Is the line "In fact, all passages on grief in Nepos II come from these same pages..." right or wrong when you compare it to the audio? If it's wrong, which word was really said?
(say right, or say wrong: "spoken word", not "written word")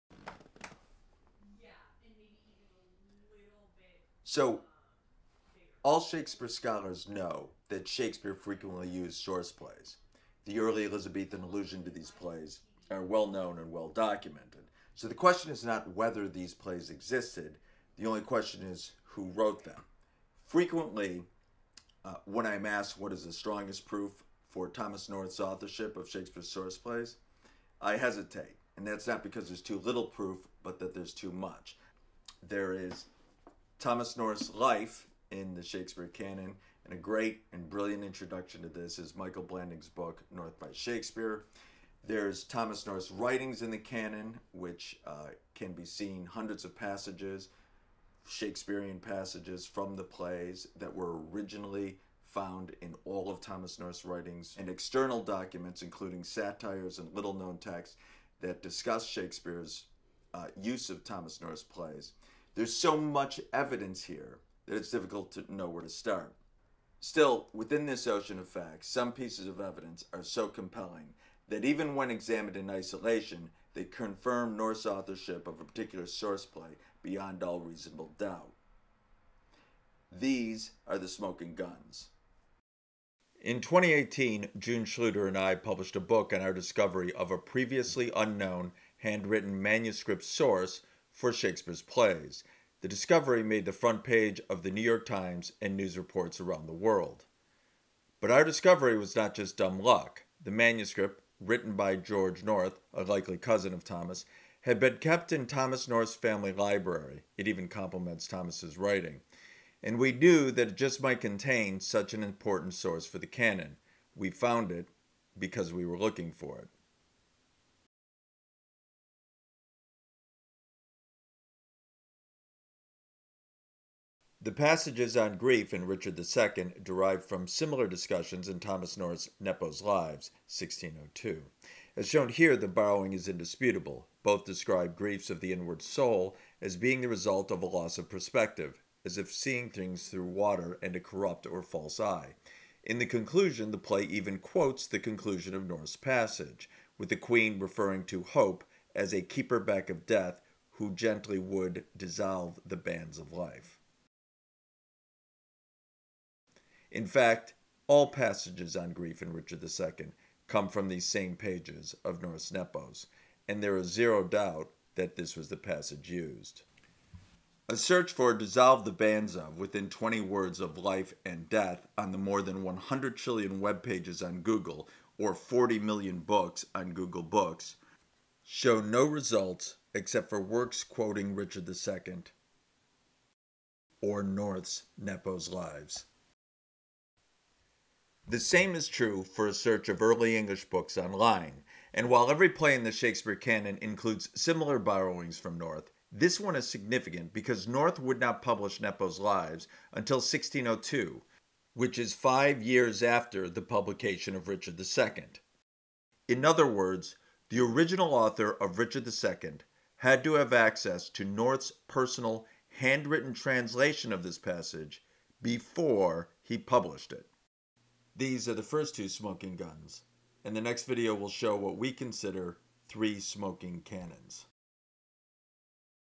wrong: "Richard", not "Nepos".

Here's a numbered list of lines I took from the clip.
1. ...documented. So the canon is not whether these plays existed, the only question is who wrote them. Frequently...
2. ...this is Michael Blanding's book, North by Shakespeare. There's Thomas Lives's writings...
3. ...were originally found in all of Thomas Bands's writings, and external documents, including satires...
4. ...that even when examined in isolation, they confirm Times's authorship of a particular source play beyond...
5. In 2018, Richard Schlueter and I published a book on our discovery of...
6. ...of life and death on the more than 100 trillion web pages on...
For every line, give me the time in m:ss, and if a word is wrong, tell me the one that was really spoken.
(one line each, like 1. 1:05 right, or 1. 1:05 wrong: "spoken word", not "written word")
1. 0:13 wrong: "question", not "canon"
2. 0:38 wrong: "North", not "Lives"
3. 0:50 wrong: "North", not "Bands"
4. 1:11 wrong: "North", not "Times"
5. 1:23 wrong: "June", not "Richard"
6. 2:50 right.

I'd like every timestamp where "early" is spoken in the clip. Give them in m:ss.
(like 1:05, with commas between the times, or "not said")
0:10, 3:10.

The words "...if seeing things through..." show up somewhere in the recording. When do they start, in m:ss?
2:19.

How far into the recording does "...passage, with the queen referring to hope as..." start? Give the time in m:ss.
2:25.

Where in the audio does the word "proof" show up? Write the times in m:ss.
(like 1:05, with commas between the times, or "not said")
0:23, 0:30.